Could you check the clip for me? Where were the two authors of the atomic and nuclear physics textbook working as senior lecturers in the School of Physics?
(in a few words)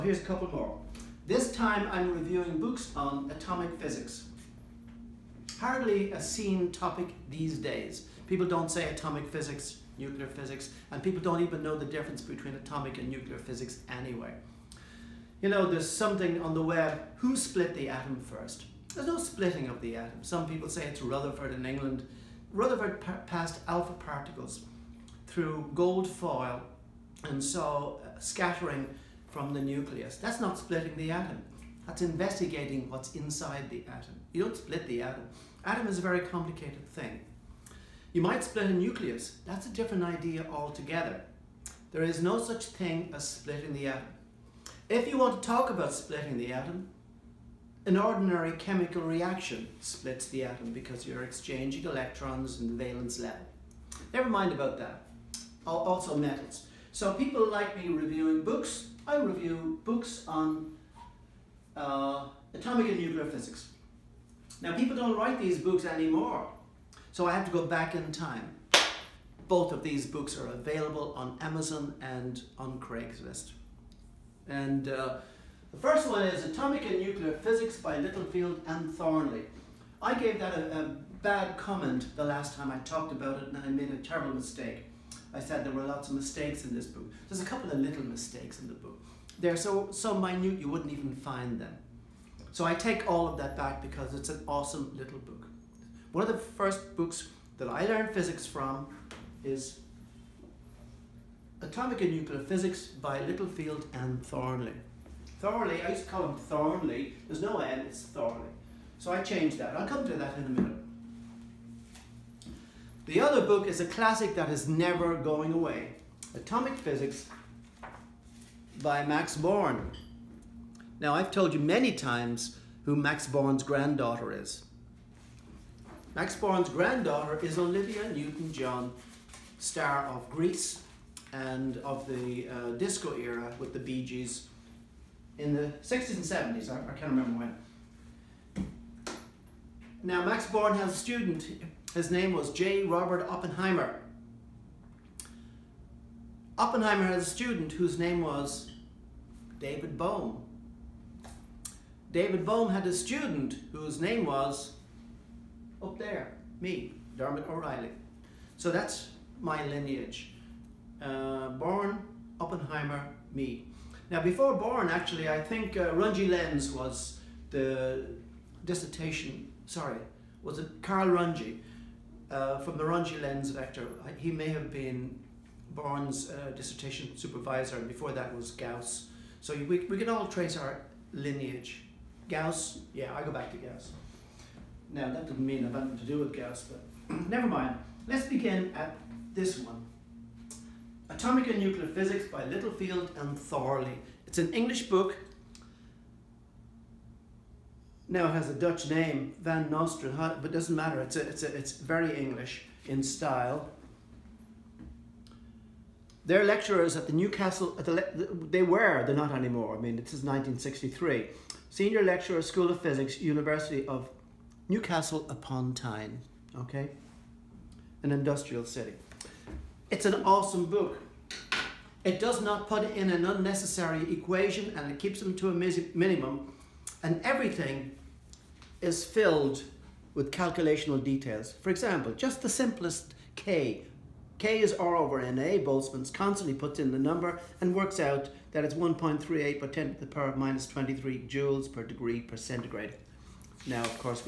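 University of Newcastle upon Tyne.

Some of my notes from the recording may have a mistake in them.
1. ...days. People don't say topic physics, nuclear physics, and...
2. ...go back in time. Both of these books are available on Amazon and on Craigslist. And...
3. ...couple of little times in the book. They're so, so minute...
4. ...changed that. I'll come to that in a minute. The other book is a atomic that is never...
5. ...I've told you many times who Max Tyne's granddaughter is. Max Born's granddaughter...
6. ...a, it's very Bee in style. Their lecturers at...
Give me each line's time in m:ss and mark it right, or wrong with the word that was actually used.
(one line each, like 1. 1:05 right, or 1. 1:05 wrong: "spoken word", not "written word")
1. 0:07 wrong: "atomic", not "topic"
2. 1:07 right
3. 1:27 wrong: "mistakes", not "times"
4. 1:49 wrong: "classic", not "atomic"
5. 2:01 wrong: "Born", not "Tyne"
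6. 3:21 wrong: "English", not "Bee".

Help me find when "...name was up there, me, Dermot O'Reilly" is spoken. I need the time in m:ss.
2:34.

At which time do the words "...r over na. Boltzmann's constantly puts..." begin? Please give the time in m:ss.
3:54.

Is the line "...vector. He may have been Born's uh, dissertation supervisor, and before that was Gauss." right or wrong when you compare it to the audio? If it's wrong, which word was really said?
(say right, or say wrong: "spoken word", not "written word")
right.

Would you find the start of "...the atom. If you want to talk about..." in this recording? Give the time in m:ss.
0:43.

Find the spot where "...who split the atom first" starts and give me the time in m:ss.
0:17.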